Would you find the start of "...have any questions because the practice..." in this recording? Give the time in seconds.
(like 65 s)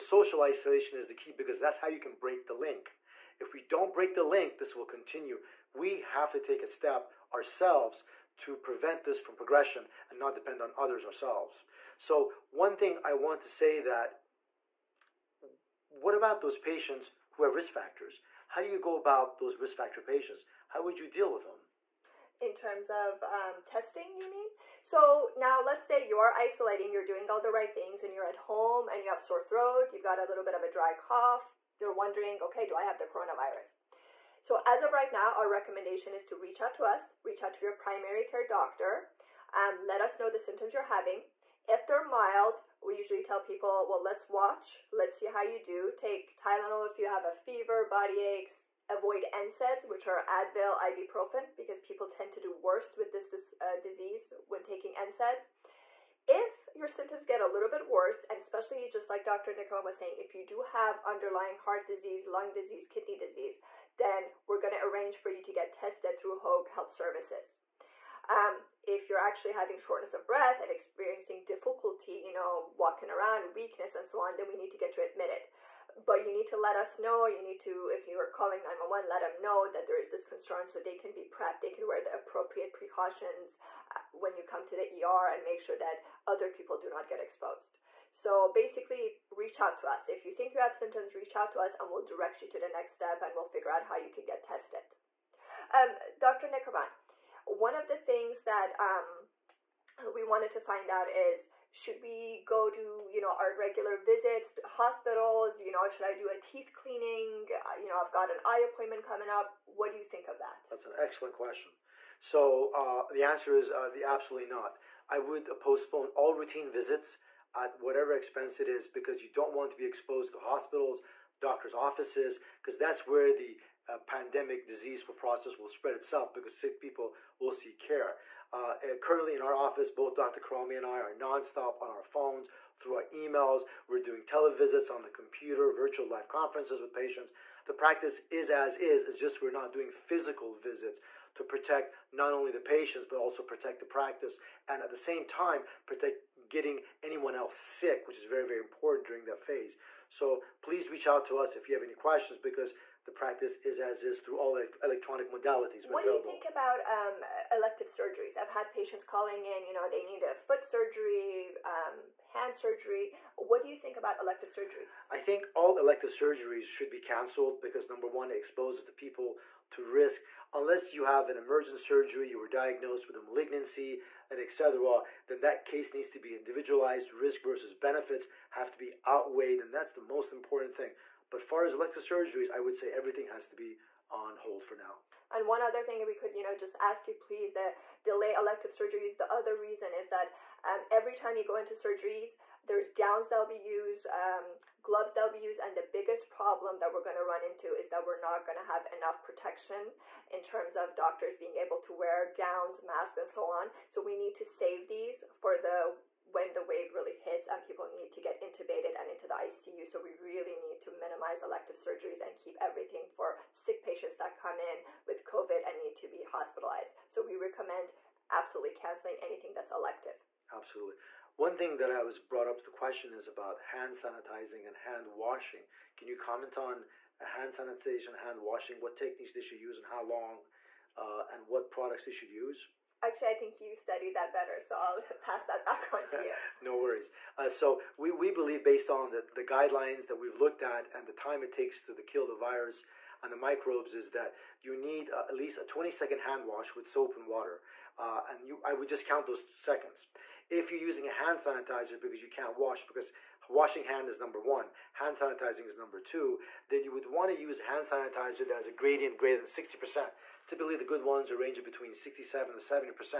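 151 s.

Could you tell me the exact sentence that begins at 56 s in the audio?
If your symptoms get a little bit worse, and especially just like Dr.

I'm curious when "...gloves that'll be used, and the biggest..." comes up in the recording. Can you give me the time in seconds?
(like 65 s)
194 s.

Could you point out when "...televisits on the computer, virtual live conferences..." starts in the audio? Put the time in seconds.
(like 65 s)
134 s.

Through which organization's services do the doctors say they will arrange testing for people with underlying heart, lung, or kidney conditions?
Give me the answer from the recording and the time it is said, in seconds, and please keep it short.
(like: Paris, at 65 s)
Hoag Health Services, at 66 s.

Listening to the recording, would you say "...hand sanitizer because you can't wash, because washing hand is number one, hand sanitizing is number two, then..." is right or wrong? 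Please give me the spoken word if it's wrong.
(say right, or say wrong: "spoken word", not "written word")
right.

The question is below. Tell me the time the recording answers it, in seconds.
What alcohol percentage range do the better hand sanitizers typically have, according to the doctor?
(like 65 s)
261 s.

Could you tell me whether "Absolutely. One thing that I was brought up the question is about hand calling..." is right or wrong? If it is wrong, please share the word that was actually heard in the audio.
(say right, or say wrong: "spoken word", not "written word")
wrong: "sanitizing", not "calling".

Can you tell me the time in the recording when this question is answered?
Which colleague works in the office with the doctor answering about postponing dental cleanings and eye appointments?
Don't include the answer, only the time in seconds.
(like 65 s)
130 s.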